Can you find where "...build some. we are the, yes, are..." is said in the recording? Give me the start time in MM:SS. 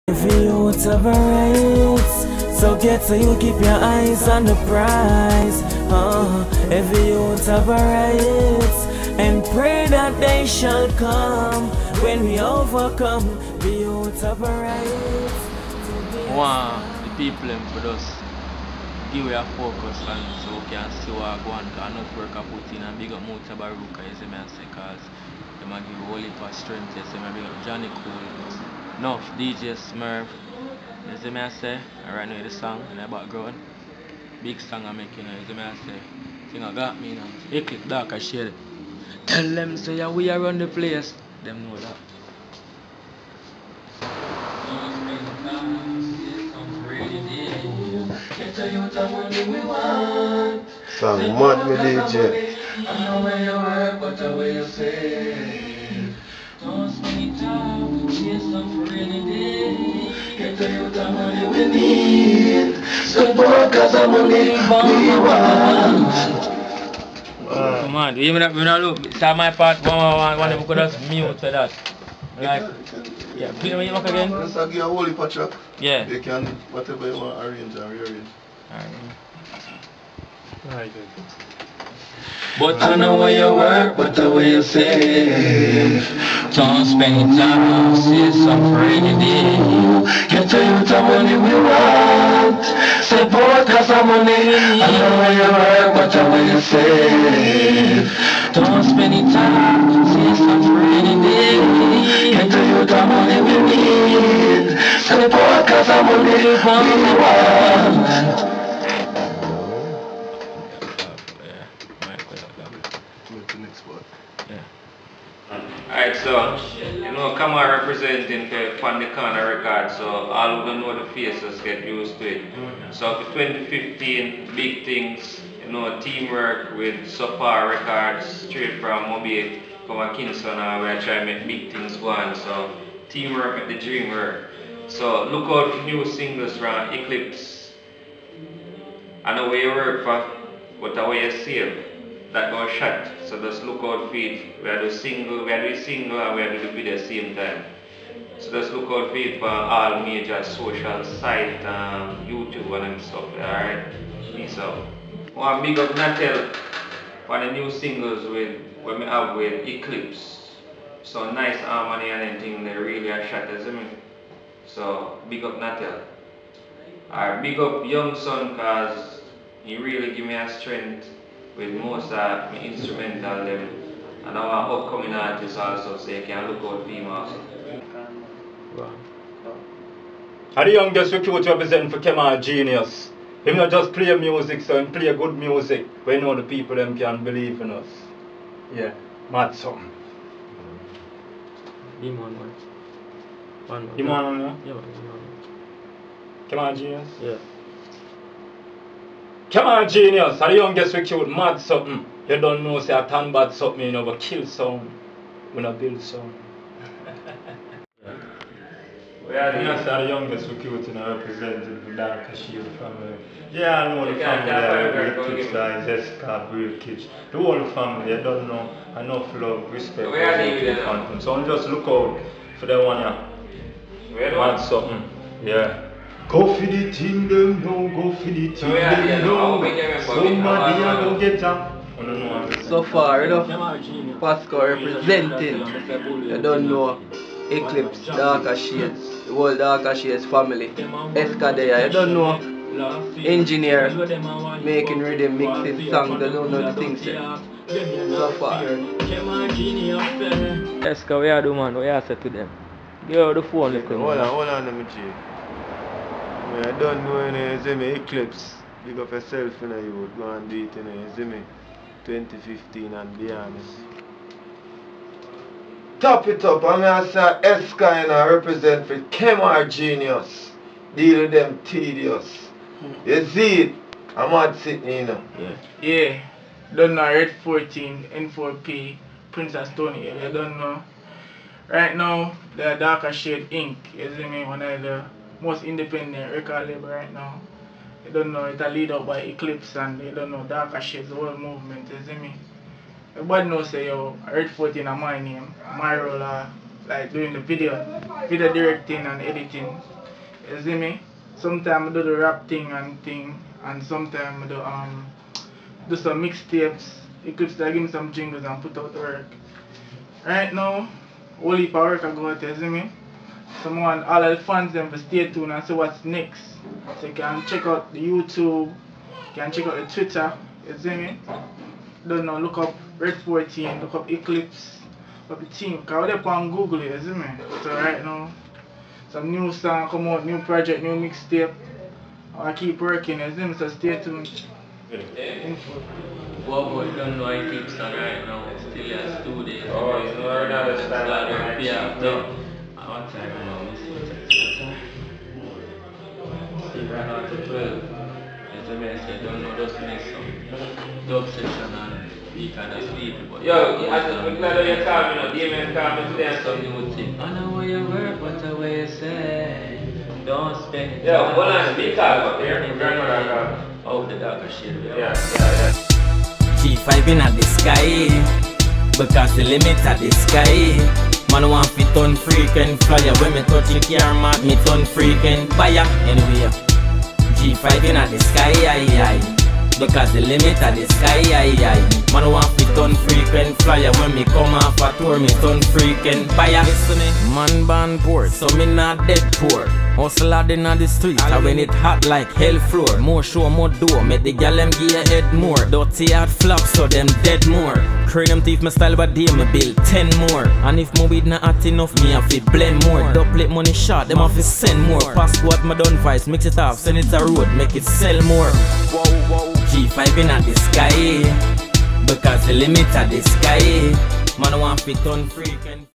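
03:25.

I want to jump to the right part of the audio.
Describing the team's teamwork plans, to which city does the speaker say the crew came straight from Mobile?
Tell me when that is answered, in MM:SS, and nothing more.
02:10.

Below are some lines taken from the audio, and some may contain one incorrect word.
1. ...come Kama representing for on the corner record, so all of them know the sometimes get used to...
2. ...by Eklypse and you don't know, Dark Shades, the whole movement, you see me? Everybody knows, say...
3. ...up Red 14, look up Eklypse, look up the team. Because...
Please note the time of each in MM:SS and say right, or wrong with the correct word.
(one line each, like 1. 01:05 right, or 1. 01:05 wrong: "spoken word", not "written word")
1. 01:57 wrong: "faces", not "sometimes"
2. 04:49 right
3. 05:22 right.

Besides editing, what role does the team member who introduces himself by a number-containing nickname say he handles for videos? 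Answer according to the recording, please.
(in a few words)
Video directing.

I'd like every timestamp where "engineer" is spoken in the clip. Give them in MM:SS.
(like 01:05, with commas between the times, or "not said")
04:03.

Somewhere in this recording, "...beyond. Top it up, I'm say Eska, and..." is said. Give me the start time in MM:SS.
04:23.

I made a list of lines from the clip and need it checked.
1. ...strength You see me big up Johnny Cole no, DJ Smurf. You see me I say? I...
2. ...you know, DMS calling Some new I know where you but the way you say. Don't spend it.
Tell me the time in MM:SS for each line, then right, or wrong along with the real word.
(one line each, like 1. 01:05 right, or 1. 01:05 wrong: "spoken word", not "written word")
1. 00:26 right
2. 05:55 right.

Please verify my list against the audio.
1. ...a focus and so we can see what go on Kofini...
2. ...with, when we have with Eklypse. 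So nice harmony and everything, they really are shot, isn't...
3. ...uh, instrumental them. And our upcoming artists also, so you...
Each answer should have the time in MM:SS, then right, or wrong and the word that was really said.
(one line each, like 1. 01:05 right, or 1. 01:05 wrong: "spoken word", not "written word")
1. 00:19 wrong: "Cause", not "Kofini"
2. 02:38 right
3. 02:52 right.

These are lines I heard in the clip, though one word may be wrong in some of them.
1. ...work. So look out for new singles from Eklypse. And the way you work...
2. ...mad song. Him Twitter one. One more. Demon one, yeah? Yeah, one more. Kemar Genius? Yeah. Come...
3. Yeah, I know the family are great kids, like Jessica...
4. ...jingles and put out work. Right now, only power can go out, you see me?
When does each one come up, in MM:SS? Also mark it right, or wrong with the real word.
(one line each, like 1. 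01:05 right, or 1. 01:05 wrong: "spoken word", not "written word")
1. 02:14 right
2. 03:09 wrong: "Demon", not "Twitter"
3. 03:33 right
4. 05:08 right.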